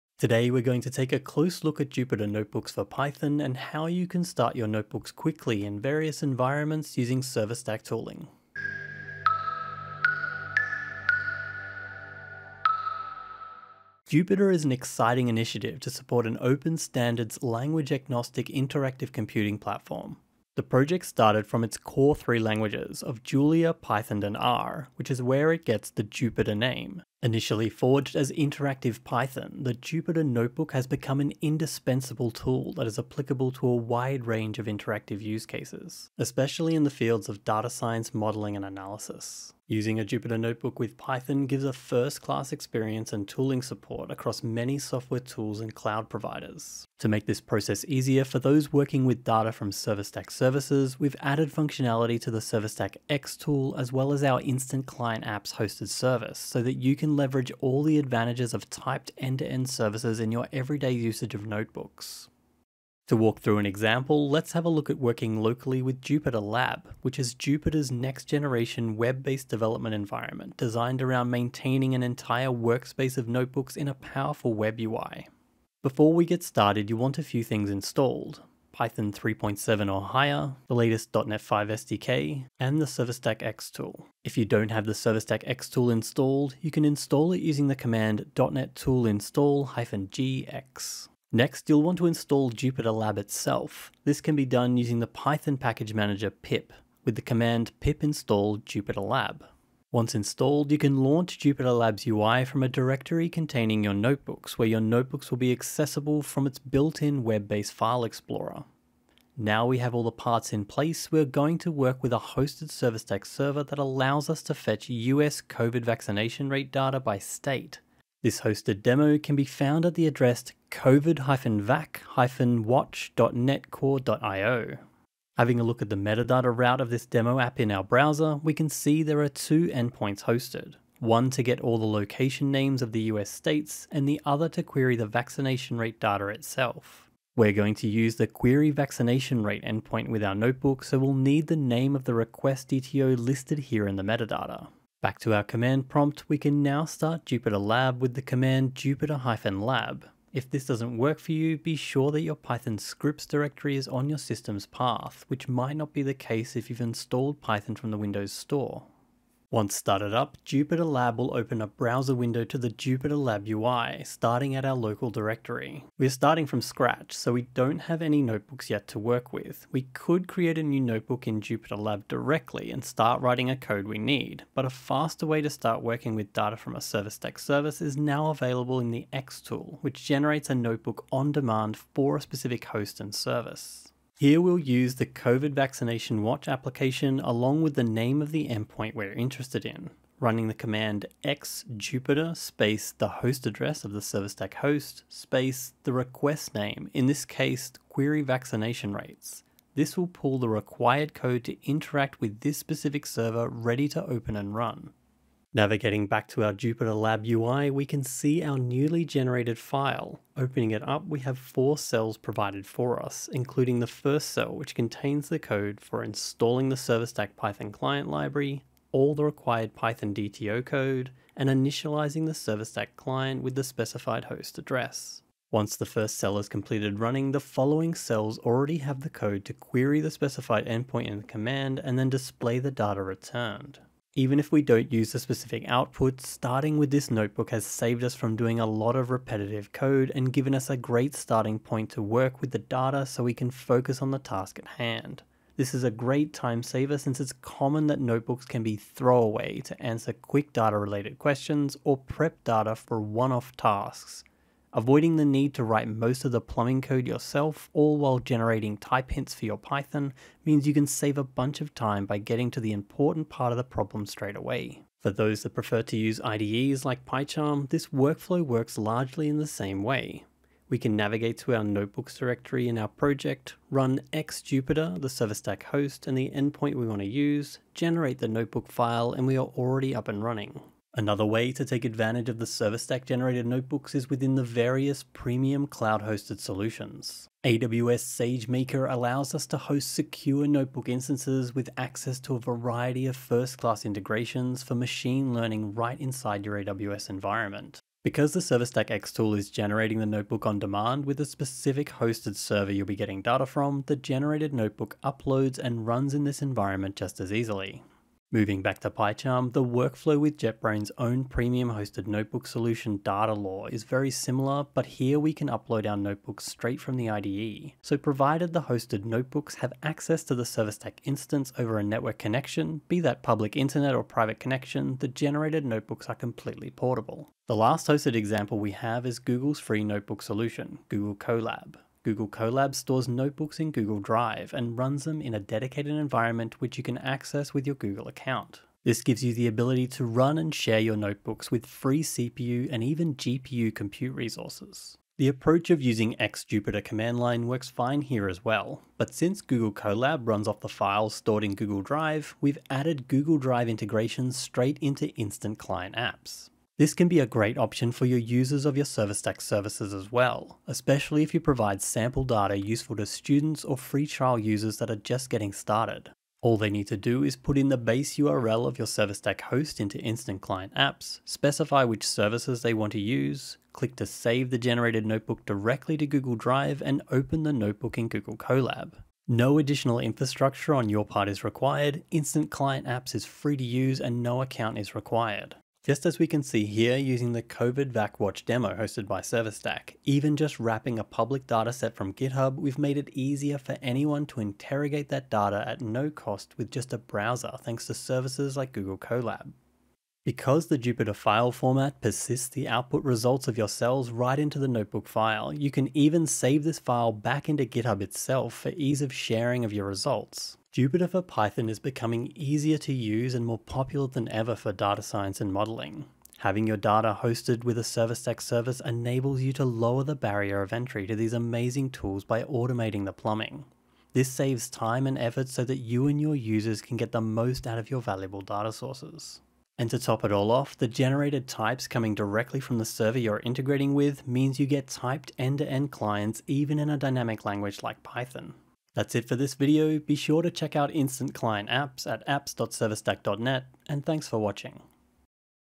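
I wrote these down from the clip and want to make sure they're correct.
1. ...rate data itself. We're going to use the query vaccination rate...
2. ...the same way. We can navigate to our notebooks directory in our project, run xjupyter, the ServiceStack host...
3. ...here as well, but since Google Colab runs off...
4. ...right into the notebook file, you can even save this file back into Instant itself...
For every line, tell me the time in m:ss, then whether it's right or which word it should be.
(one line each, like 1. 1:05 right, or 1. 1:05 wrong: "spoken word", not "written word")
1. 2:15 right
2. 4:29 right
3. 5:48 right
4. 6:44 wrong: "GitHub", not "Instant".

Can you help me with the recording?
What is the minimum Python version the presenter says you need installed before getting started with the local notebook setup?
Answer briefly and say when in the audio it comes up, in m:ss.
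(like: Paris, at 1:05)
3.7, at 1:18.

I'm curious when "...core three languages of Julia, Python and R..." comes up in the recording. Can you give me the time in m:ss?
0:21.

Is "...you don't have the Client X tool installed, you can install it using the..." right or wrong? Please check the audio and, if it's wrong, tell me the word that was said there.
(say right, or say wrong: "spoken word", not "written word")
wrong: "ServiceStack", not "Client".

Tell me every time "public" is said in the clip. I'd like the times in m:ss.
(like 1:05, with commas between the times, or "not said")
5:23, 6:31.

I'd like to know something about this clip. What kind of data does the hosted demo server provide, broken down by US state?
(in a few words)
COVID vaccination rate.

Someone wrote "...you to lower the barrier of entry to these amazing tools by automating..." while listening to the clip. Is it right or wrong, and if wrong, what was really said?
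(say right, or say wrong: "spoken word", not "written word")
right.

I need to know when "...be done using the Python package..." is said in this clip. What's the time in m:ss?
1:34.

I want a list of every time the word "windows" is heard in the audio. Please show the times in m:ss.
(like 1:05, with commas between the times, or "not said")
2:37, 2:42.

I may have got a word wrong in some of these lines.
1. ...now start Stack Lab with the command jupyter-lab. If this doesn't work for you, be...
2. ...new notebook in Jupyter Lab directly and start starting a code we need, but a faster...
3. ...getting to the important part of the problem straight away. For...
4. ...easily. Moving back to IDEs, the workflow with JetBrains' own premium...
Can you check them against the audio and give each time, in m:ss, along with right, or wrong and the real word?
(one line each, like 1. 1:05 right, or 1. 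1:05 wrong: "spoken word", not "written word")
1. 2:26 wrong: "Jupyter", not "Stack"
2. 2:50 wrong: "writing", not "starting"
3. 4:22 right
4. 5:07 wrong: "PyCharm", not "IDEs".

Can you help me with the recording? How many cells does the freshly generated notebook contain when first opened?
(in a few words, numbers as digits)
4.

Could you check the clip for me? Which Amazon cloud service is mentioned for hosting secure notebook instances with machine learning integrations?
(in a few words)
AWS SageMaker.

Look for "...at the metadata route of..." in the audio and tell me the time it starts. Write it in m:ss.
2:05.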